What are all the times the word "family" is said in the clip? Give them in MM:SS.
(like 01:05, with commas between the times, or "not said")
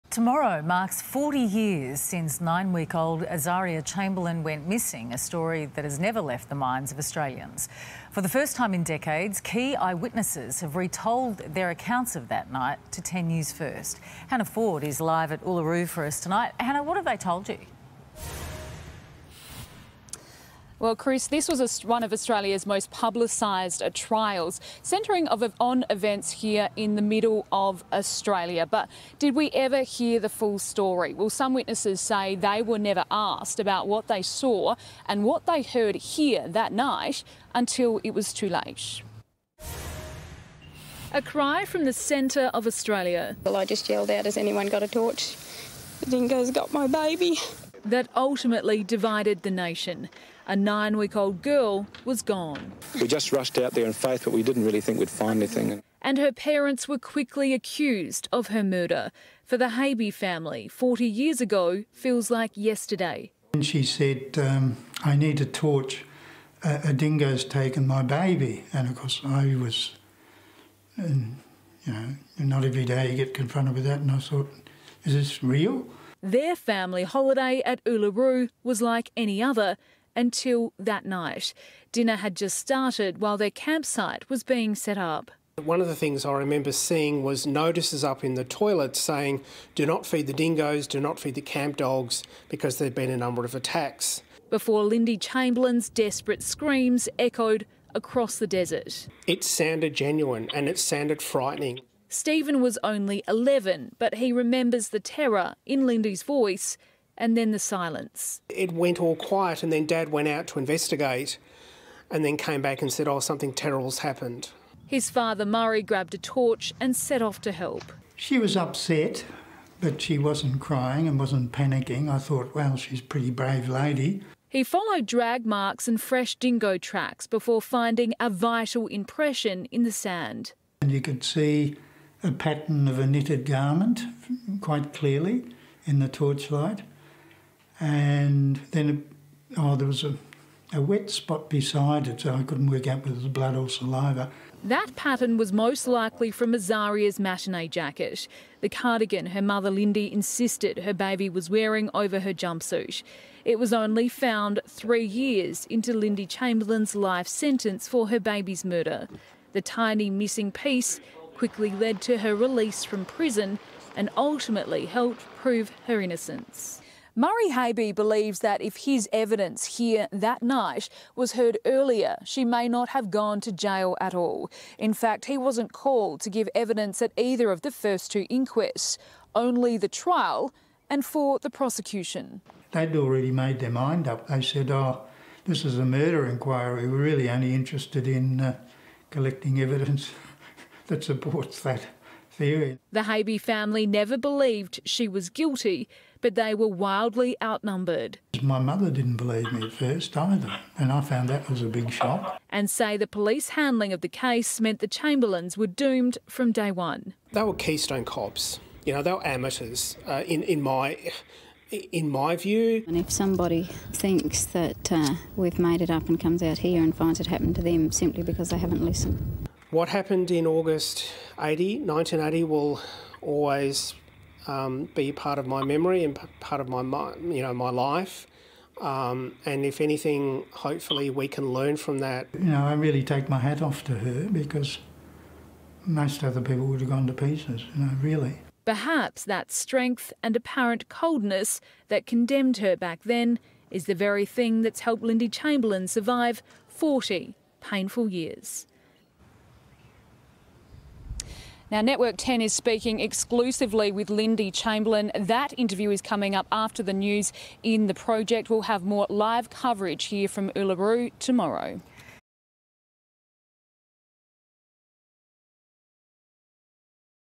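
01:00, 01:16, 03:13.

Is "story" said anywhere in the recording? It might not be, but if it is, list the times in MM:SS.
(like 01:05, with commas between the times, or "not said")
00:05, 00:30.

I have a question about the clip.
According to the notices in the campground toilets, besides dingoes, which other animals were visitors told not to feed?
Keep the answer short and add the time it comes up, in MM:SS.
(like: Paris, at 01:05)
camp dogs, at 01:31.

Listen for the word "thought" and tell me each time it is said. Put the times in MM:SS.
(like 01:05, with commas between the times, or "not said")
01:14, 02:02.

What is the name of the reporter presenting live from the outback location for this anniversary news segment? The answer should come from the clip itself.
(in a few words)
Hannah Ford.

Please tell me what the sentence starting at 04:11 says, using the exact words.
Now, Network 10 is speaking exclusively with Lindy Chamberlain.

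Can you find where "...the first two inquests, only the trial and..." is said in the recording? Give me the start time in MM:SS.
02:57.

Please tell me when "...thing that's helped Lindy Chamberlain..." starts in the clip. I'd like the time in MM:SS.
04:04.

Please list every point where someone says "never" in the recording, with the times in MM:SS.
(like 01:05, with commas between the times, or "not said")
00:06, 00:32, 03:13.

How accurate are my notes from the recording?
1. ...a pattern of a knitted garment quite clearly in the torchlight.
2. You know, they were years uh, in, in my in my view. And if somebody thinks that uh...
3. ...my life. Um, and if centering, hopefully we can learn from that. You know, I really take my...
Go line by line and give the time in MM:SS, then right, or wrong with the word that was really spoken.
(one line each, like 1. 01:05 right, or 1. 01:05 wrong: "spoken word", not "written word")
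1. 02:12 right
2. 03:28 wrong: "amateurs", not "years"
3. 03:47 wrong: "anything", not "centering".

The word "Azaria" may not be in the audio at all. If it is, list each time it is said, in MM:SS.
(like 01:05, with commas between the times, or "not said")
00:03, 02:26.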